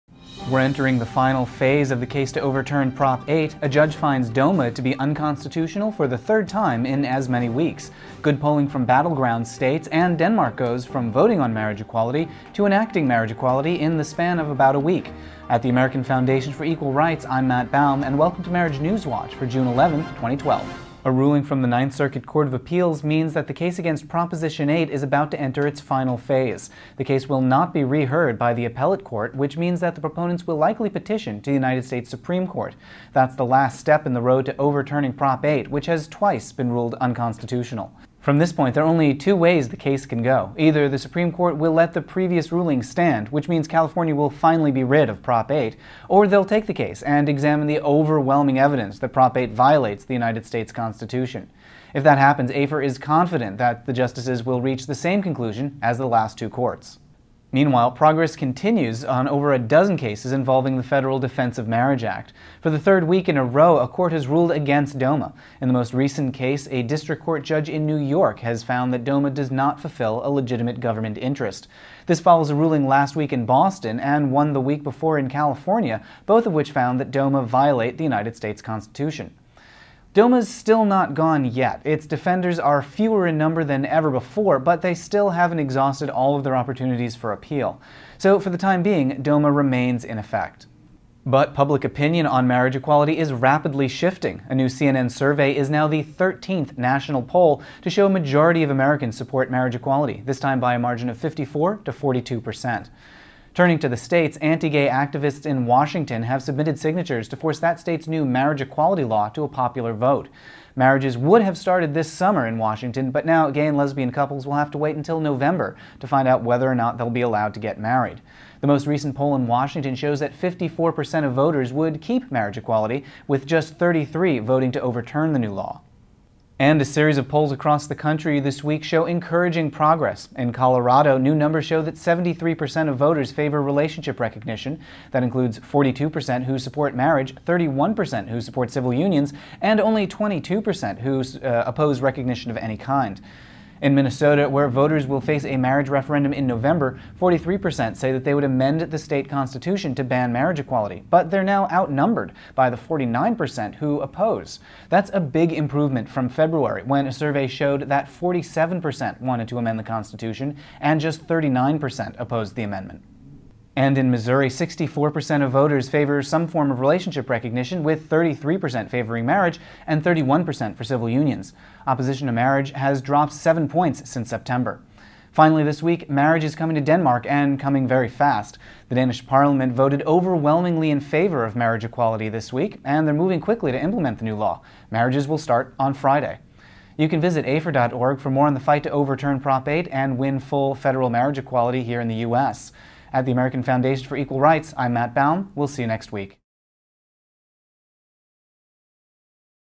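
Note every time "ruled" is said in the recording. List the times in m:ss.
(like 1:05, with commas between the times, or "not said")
0:36, 1:04.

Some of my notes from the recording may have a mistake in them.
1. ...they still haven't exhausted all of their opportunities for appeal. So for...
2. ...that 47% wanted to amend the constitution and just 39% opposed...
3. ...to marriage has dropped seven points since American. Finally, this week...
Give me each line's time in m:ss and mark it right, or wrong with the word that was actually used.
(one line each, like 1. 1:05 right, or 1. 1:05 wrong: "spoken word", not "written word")
1. 1:24 right
2. 2:37 right
3. 2:52 wrong: "September", not "American".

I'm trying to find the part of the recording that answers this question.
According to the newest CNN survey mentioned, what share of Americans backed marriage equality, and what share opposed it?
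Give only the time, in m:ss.
1:41.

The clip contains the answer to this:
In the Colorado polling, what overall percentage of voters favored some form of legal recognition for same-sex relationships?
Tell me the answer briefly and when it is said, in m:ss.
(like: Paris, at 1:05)
73%, at 2:11.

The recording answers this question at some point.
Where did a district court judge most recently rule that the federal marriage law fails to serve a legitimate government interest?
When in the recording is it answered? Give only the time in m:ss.
1:07.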